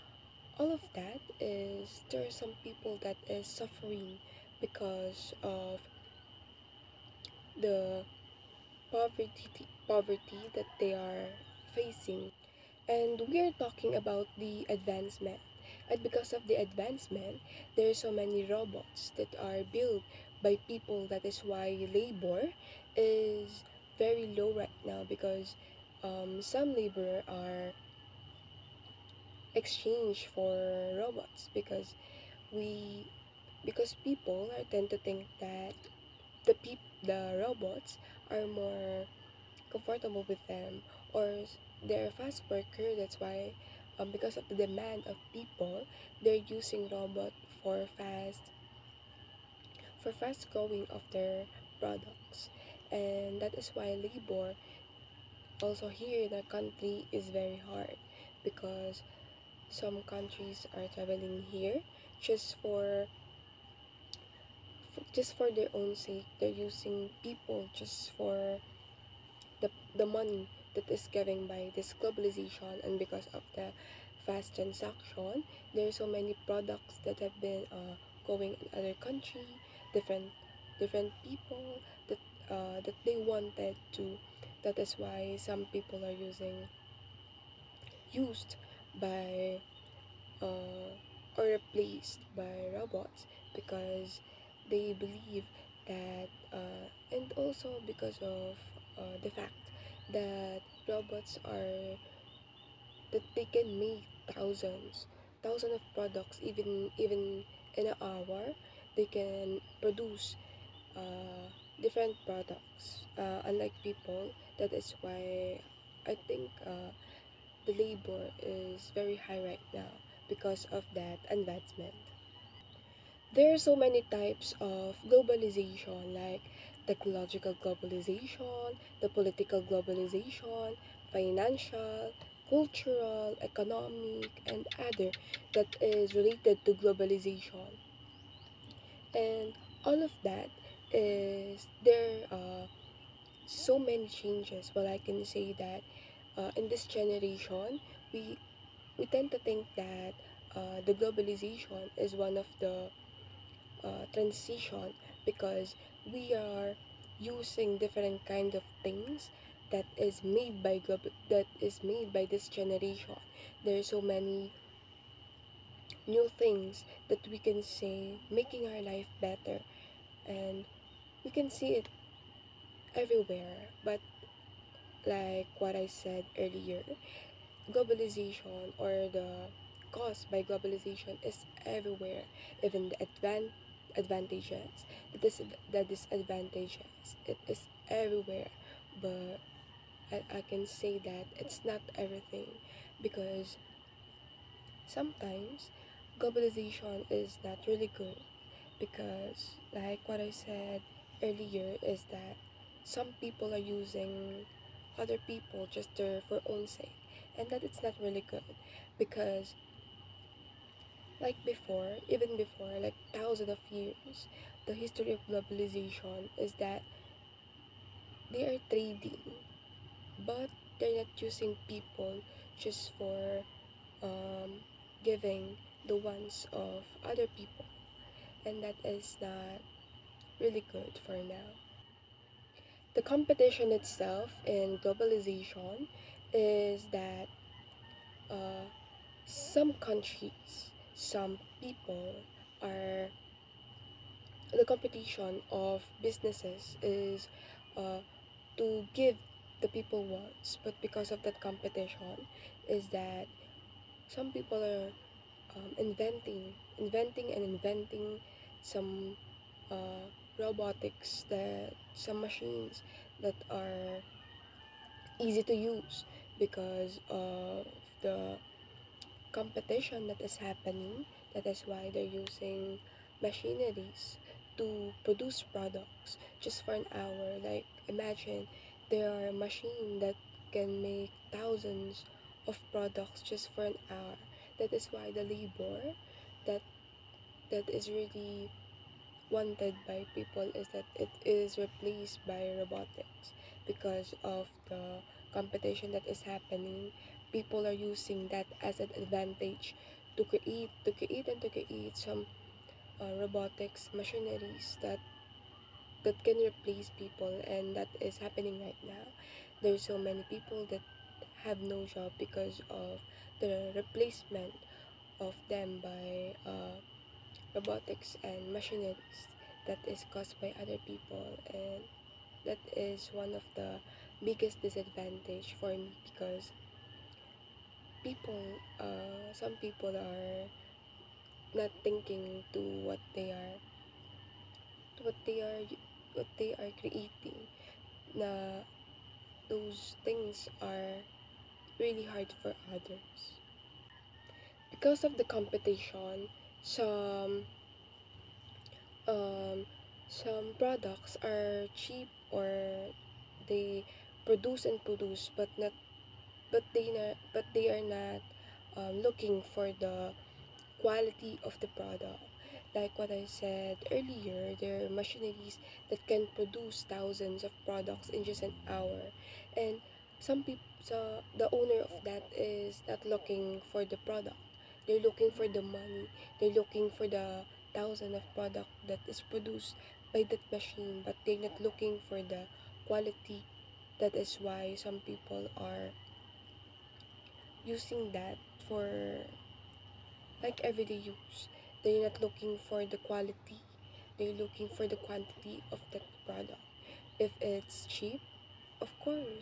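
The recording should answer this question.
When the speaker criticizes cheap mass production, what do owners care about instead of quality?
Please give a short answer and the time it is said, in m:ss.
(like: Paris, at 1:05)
quantity, at 6:34.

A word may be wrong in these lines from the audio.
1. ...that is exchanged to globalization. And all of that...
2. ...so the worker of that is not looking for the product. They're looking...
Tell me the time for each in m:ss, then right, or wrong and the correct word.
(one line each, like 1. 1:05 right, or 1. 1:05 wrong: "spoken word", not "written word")
1. 2:15 wrong: "related", not "exchanged"
2. 6:10 wrong: "owner", not "worker".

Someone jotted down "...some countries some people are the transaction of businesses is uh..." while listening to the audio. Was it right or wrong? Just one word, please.
wrong.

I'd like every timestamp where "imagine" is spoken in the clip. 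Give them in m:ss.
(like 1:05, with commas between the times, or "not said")
4:37.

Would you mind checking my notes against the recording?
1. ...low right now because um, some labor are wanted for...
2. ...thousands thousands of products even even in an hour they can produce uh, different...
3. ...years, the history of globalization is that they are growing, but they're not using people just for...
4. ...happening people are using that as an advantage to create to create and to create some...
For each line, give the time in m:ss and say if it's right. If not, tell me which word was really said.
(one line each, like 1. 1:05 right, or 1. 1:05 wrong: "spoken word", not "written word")
1. 0:24 wrong: "exchanged", not "wanted"
2. 1:44 right
3. 3:33 wrong: "trading", not "growing"
4. 4:56 right.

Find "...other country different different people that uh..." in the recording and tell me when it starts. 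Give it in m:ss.
1:18.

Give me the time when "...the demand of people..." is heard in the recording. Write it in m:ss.
0:44.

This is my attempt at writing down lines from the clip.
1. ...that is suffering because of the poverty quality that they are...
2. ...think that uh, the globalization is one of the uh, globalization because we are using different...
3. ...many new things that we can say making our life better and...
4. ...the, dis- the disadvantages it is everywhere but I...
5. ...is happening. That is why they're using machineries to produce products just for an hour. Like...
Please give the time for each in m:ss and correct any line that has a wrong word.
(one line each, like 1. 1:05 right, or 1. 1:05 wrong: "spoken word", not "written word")
1. 0:03 wrong: "poverty", not "quality"
2. 2:29 wrong: "transition", not "globalization"
3. 2:44 right
4. 3:05 right
5. 4:30 right.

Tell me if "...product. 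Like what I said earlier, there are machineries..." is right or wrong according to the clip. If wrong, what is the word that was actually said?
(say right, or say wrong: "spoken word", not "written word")
right.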